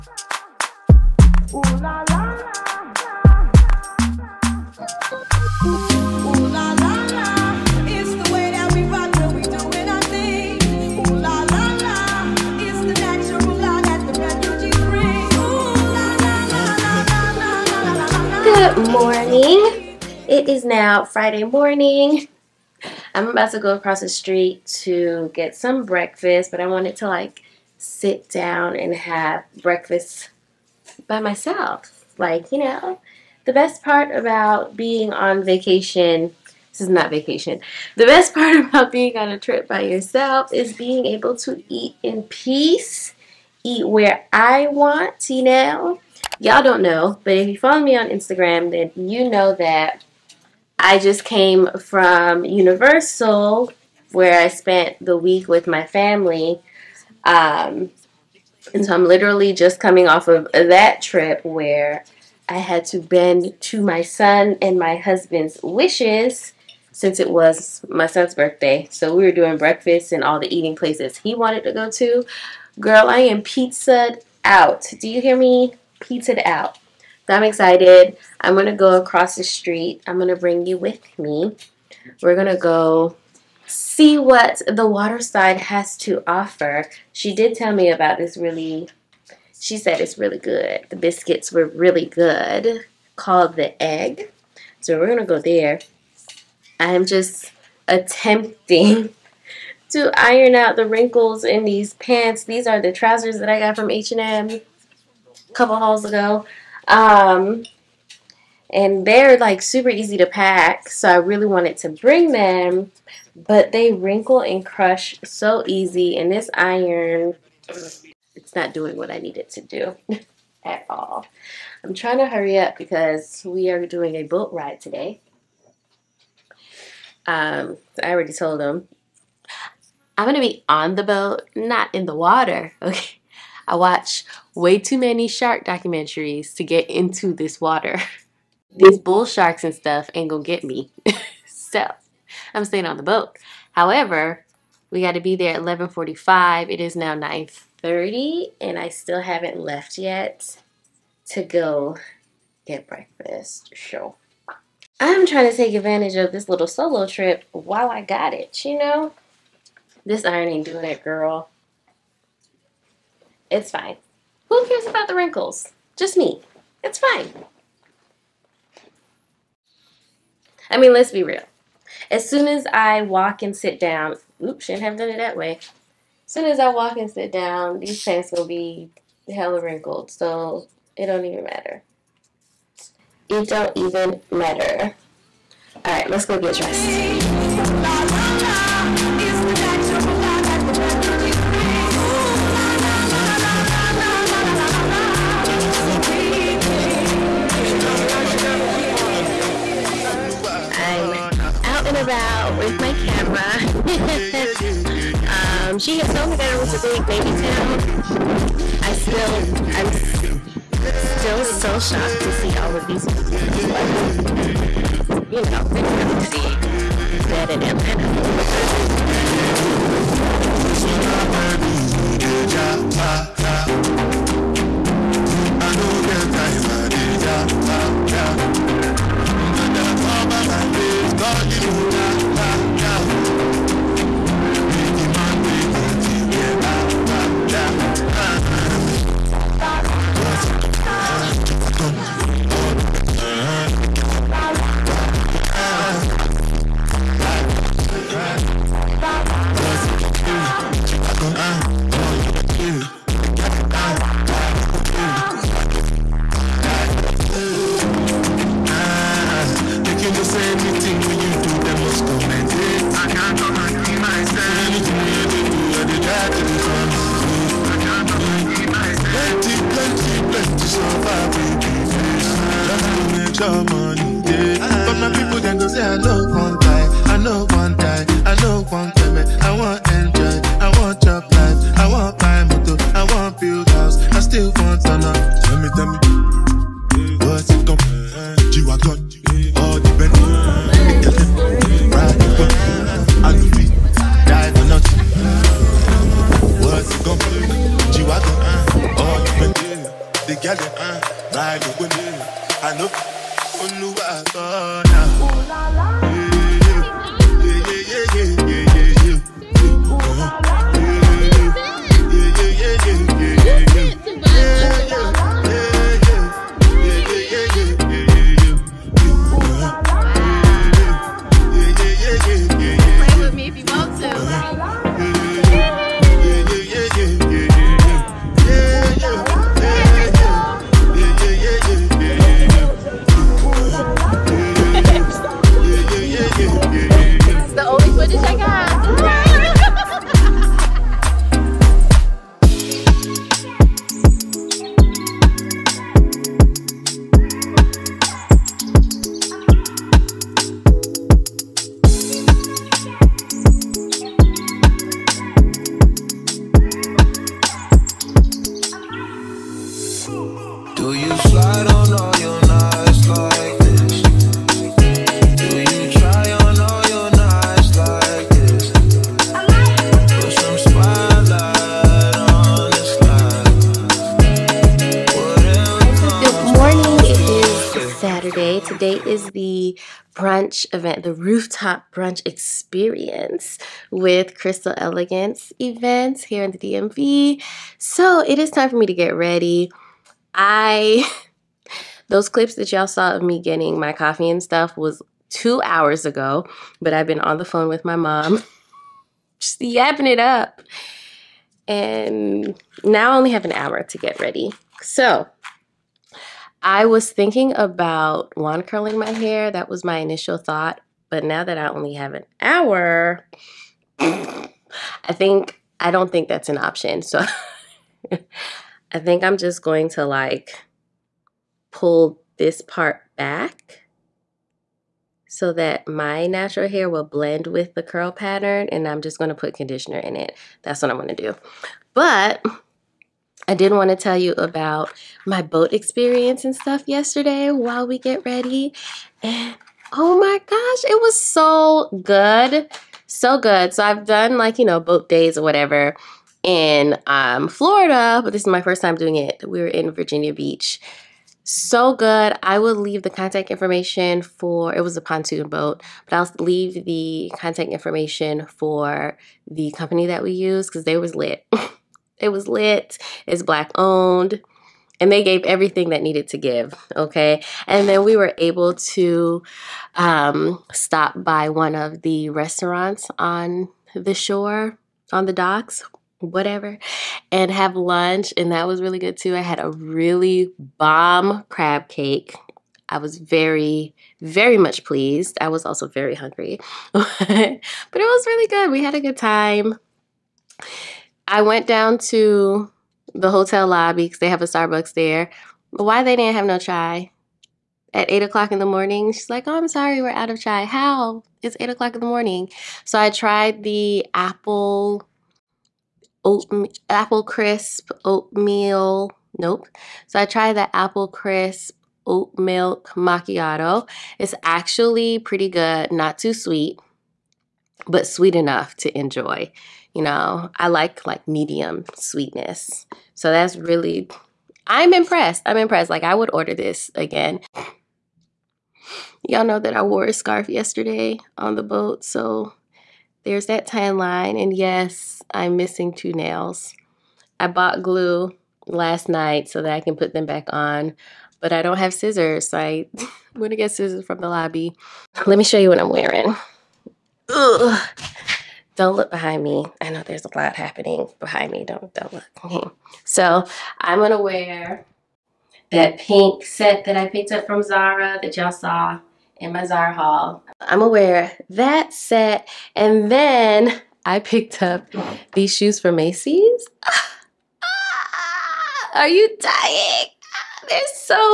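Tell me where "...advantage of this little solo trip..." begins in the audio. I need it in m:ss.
2:35.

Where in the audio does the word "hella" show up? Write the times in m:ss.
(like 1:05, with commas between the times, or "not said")
2:59.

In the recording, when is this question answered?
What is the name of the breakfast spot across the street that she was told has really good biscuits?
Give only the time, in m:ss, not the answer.
1:33.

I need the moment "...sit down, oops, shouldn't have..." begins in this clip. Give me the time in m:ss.
2:53.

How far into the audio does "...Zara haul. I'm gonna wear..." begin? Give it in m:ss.
9:19.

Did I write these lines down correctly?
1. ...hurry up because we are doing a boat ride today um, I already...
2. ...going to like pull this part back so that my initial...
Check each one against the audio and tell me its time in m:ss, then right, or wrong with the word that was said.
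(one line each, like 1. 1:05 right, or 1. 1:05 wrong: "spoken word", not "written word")
1. 2:02 right
2. 6:59 wrong: "natural", not "initial".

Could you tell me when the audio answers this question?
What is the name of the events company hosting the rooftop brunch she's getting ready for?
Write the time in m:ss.
6:24.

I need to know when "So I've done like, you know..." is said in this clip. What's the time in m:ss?
7:23.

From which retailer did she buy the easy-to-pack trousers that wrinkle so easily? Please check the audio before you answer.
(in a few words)
H&M.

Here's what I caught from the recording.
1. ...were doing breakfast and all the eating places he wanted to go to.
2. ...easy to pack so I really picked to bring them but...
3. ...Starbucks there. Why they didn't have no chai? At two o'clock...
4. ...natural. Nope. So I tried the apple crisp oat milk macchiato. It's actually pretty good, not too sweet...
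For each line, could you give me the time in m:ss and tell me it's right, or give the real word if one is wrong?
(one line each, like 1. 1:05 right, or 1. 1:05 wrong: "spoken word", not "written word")
1. 1:09 right
2. 1:49 wrong: "wanted", not "picked"
3. 8:14 wrong: "eight", not "two"
4. 8:28 wrong: "oatmeal", not "natural".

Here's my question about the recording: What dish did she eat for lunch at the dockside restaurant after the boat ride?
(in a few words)
crab cake.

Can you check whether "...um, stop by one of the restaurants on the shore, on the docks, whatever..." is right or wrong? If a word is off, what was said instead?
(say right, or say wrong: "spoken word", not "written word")
right.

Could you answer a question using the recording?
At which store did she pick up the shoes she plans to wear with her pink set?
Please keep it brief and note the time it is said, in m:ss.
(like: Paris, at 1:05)
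Macy's, at 9:25.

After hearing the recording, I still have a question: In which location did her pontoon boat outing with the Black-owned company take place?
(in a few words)
Virginia Beach.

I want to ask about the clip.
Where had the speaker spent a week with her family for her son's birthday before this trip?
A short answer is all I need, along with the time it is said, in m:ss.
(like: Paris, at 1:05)
Universal, at 0:52.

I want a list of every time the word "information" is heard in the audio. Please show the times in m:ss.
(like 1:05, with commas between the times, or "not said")
7:33, 7:37.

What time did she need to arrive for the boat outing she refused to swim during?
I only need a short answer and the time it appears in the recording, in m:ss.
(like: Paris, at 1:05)
11:45, at 2:25.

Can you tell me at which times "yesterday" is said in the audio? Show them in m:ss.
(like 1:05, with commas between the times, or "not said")
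7:16, 8:50.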